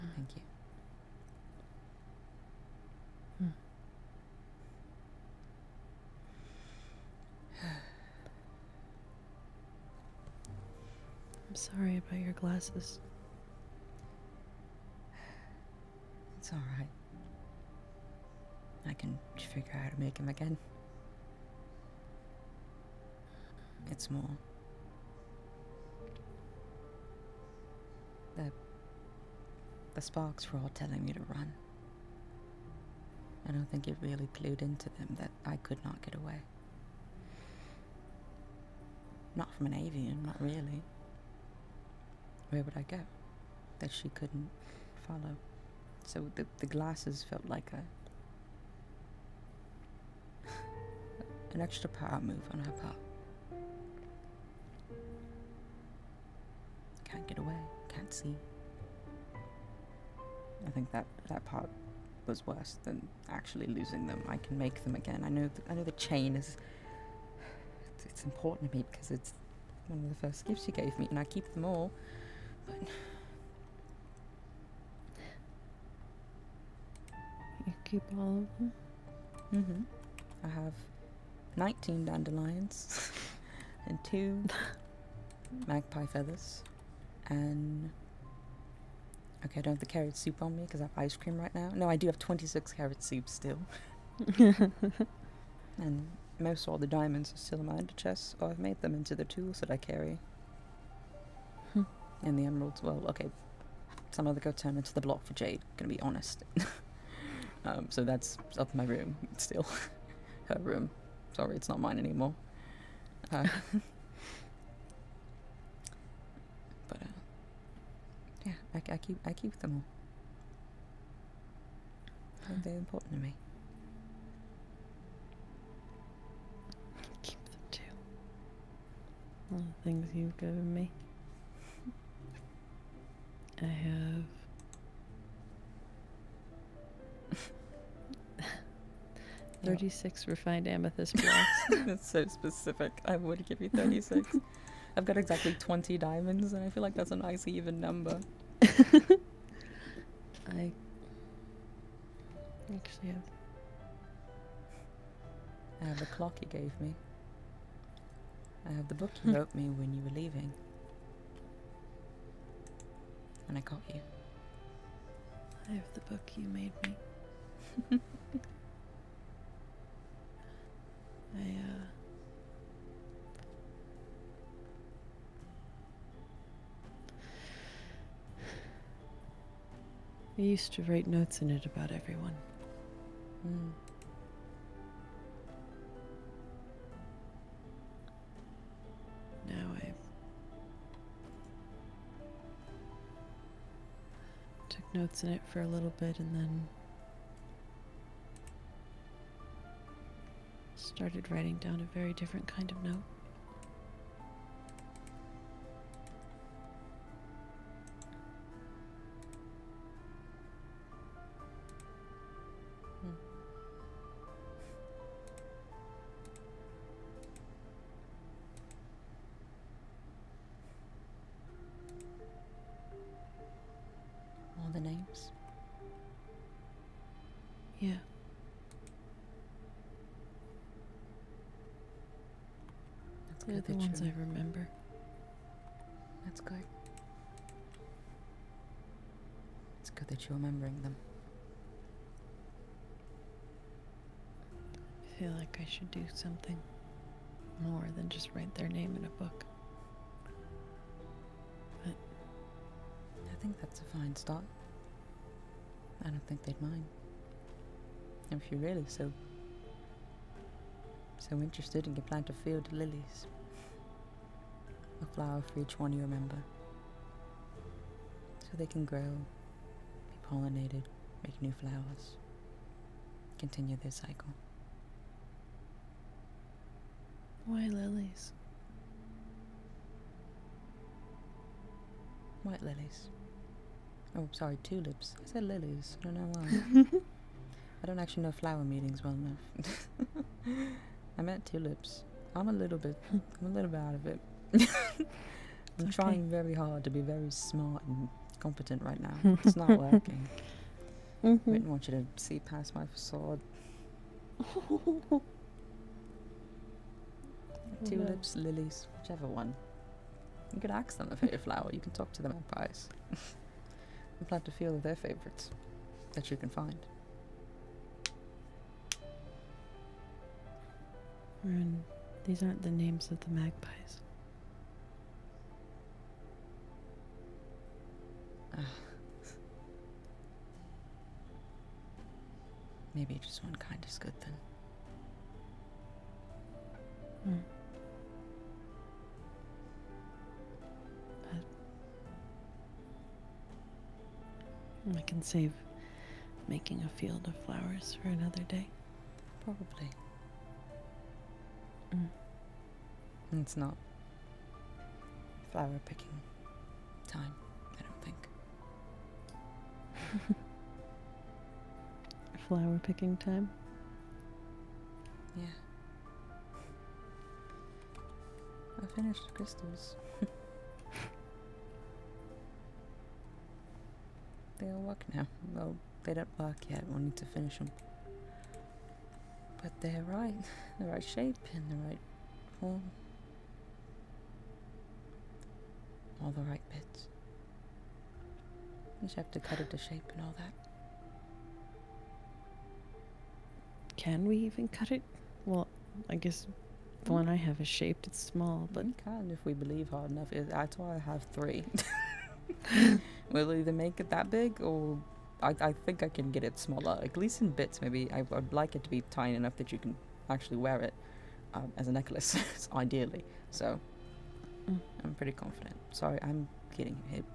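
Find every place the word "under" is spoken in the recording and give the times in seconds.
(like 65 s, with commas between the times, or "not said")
97 s.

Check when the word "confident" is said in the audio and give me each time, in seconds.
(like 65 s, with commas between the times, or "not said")
415 s.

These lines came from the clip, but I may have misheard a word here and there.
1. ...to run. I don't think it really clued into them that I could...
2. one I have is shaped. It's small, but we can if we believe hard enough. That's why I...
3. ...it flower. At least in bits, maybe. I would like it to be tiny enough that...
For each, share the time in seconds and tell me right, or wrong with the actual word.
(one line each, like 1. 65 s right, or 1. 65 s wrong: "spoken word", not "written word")
1. 31 s right
2. 397 s right
3. 406 s wrong: "smaller", not "flower".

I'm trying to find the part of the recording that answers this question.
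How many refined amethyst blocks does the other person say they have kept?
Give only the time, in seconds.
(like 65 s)
139 s.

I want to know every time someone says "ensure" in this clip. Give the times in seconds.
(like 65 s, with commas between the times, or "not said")
not said.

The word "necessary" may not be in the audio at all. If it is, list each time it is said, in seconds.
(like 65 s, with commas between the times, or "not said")
not said.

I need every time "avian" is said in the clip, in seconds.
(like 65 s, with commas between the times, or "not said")
39 s.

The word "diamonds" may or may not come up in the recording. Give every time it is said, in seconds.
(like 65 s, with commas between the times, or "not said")
96 s, 145 s.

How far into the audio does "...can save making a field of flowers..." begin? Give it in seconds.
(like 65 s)
345 s.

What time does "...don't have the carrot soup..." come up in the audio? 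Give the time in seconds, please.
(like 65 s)
89 s.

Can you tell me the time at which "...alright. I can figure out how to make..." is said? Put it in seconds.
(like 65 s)
16 s.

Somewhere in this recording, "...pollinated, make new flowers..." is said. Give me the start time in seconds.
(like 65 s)
270 s.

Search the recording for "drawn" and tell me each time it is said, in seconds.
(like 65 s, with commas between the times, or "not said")
not said.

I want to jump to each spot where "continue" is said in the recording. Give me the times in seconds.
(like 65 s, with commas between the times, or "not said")
273 s.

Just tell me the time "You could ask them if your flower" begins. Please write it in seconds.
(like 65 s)
310 s.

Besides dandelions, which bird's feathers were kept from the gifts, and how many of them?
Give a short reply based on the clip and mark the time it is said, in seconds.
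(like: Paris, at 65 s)
2 magpie feathers, at 84 s.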